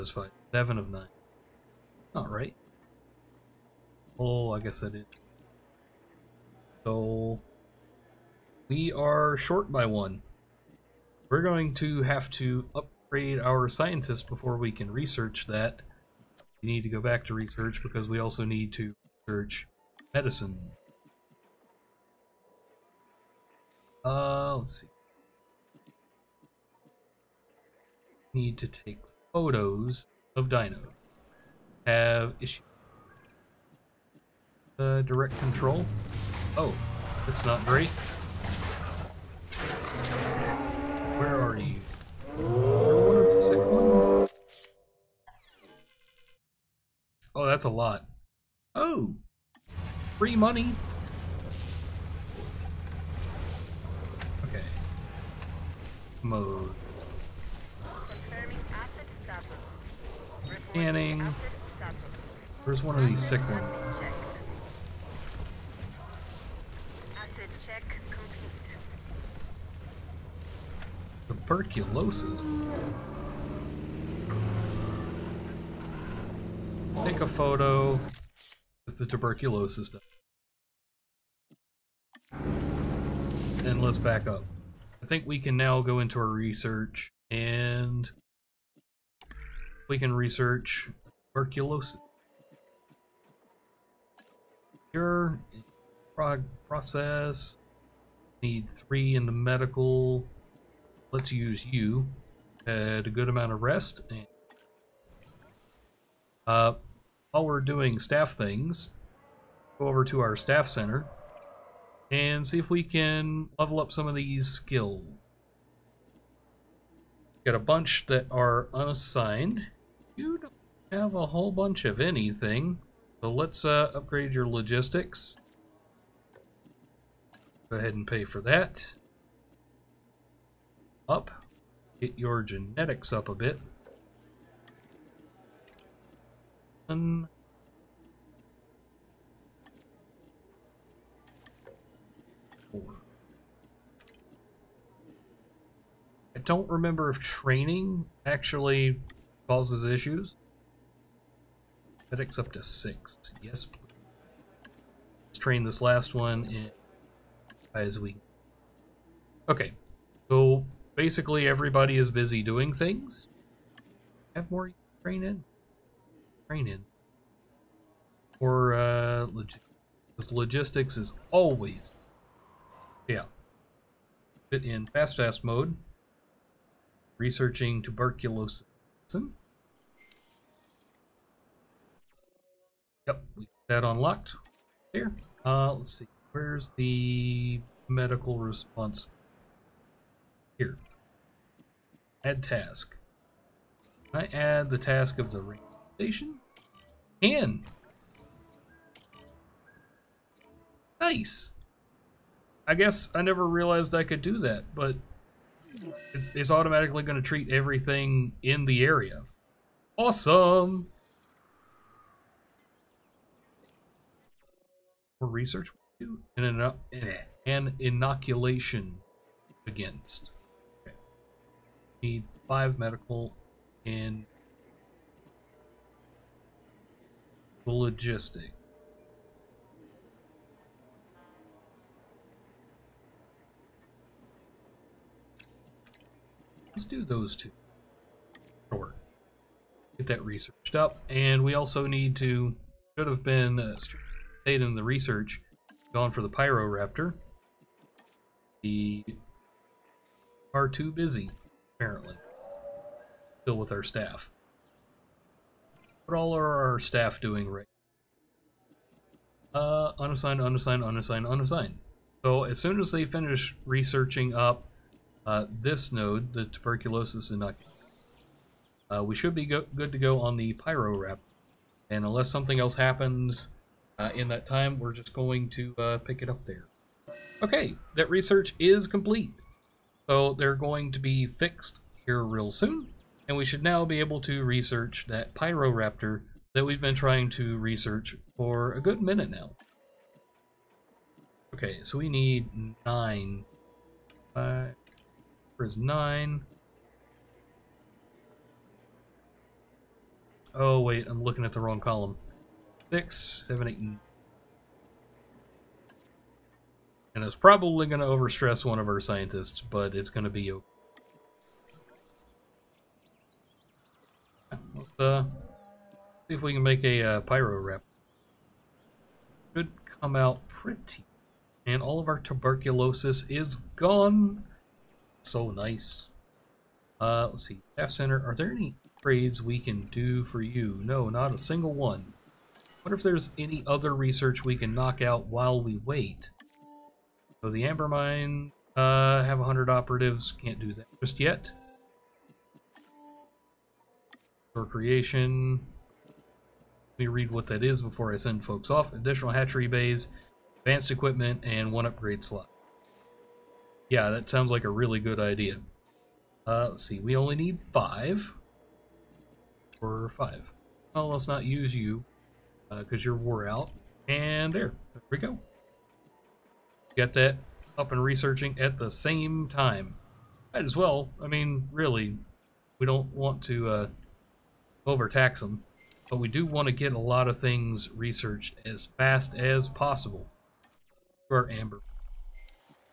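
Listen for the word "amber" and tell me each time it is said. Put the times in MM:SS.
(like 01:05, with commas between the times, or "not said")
05:37, 06:21.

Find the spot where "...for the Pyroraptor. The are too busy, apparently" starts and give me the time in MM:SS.
04:06.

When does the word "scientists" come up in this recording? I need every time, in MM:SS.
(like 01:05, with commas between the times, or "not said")
00:13, 05:09.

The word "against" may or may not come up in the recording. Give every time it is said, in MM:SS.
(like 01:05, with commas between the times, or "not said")
03:39.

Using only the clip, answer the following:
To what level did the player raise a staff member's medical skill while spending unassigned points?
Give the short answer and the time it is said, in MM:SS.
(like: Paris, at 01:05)
6, at 02:32.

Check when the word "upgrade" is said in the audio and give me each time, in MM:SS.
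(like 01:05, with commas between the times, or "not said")
00:13, 02:03, 05:51.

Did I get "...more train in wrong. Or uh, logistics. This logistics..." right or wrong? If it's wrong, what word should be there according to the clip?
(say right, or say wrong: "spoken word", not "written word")
wrong: "training", not "wrong".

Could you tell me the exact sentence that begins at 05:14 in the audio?
Let's uh, see if we can make a uh, pyro wrap.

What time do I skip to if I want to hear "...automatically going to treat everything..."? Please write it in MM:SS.
03:26.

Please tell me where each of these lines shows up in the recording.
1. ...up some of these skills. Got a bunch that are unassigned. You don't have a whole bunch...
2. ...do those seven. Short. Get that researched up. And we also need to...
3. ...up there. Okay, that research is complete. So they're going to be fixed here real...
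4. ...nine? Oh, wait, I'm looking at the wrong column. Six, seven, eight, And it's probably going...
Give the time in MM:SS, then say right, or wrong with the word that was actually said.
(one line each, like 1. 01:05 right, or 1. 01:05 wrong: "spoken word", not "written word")
1. 01:53 right
2. 03:56 wrong: "two", not "seven"
3. 04:36 right
4. 04:55 right.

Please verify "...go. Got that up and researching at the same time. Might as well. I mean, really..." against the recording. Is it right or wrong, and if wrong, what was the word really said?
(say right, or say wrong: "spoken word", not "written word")
right.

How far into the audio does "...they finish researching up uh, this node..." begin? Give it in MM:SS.
04:22.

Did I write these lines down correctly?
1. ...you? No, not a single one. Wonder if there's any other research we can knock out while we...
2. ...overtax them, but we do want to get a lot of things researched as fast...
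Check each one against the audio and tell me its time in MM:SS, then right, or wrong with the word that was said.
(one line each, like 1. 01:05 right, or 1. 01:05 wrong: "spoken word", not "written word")
1. 05:30 right
2. 06:14 right.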